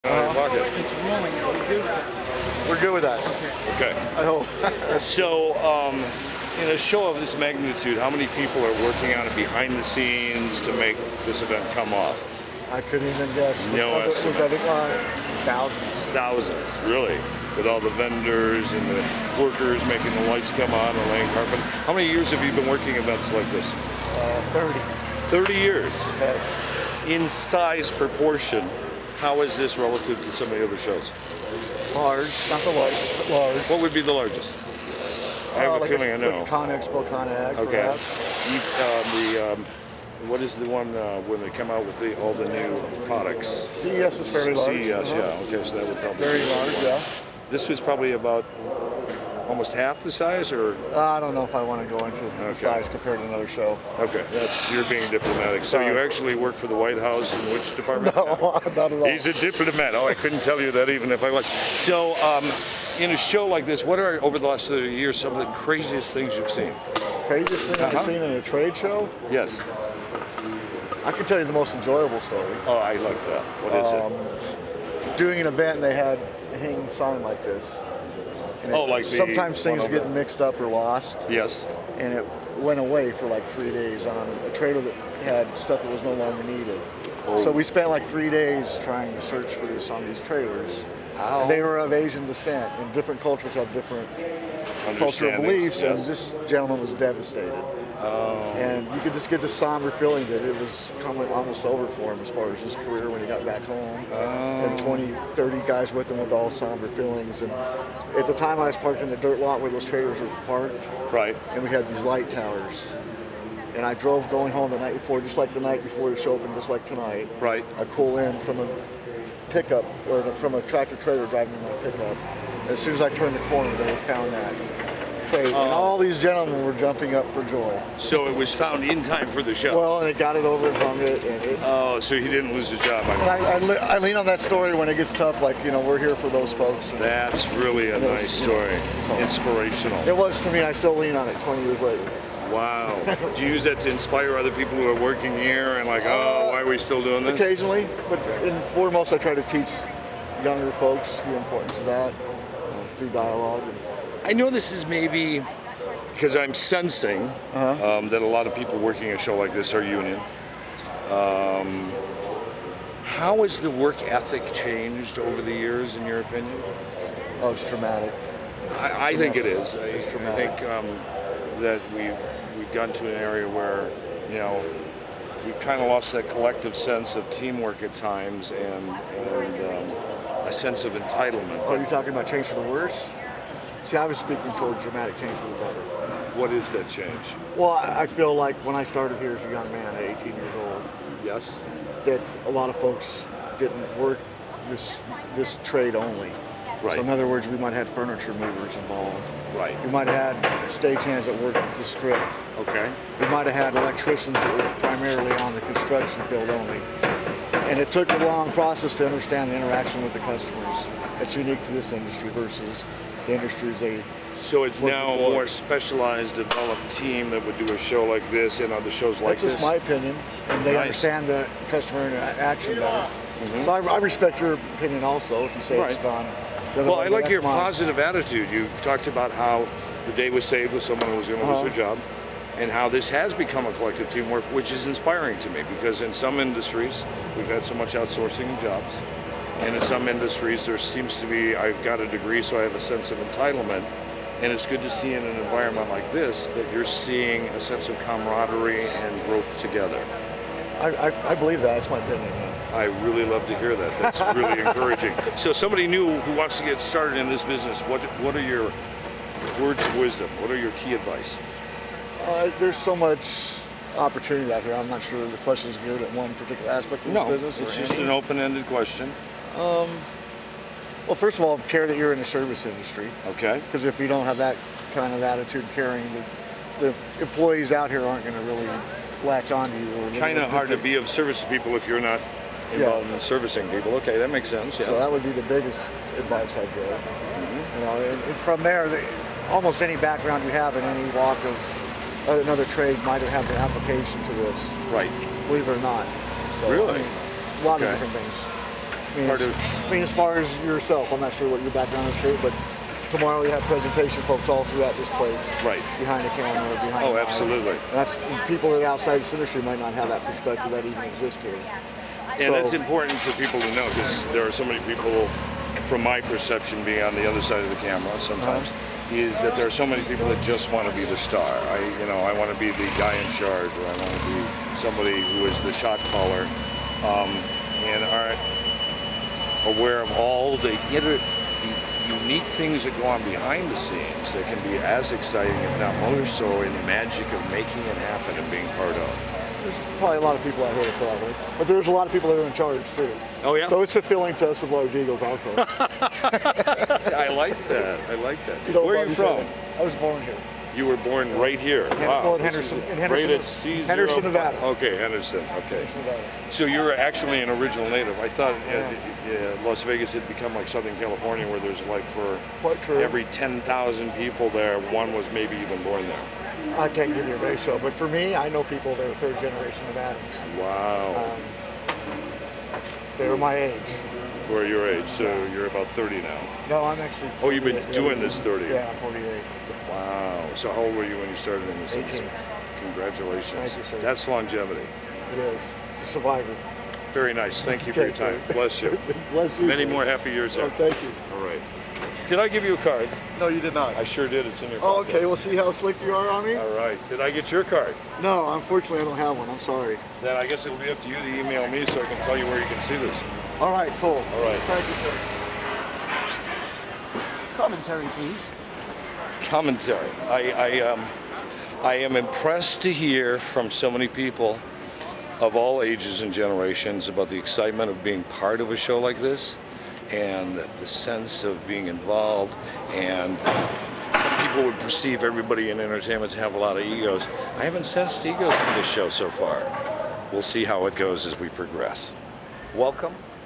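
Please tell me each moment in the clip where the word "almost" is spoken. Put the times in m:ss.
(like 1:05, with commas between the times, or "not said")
0:49, 1:41, 4:49.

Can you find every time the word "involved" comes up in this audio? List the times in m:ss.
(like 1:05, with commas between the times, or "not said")
3:18, 4:42, 7:01.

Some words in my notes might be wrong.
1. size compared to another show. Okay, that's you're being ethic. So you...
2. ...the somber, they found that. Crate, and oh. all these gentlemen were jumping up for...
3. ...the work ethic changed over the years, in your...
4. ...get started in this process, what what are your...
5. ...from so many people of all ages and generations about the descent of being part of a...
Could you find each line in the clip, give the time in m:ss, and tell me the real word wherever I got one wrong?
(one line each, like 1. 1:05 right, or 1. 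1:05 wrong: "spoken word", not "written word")
1. 0:52 wrong: "diplomatic", not "ethic"
2. 2:03 wrong: "corner", not "somber"
3. 2:43 right
4. 4:16 wrong: "business", not "process"
5. 6:53 wrong: "excitement", not "descent".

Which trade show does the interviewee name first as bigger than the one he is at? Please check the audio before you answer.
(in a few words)
Con Expo.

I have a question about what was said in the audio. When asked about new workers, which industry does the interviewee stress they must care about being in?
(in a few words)
Service industry.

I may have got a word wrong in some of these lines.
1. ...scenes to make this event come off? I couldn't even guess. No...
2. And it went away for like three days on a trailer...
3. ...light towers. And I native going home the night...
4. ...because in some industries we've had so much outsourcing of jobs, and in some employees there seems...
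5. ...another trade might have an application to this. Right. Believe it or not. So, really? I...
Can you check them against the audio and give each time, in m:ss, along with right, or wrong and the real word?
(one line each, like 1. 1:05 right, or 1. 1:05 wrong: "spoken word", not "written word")
1. 0:09 right
2. 1:21 right
3. 1:52 wrong: "drove", not "native"
4. 3:55 wrong: "industries", not "employees"
5. 4:52 right.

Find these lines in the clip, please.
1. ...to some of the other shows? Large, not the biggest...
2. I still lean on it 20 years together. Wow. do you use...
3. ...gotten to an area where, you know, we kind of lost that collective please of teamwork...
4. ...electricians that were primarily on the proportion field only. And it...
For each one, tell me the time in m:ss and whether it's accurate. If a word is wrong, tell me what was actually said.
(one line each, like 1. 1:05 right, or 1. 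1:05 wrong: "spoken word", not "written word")
1. 0:30 wrong: "largest", not "biggest"
2. 2:20 wrong: "later", not "together"
3. 2:52 wrong: "sense", not "please"
4. 3:23 wrong: "construction", not "proportion".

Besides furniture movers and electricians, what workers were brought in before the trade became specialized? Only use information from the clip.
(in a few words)
Stagehands.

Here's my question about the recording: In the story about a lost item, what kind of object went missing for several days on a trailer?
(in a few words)
Hang sign.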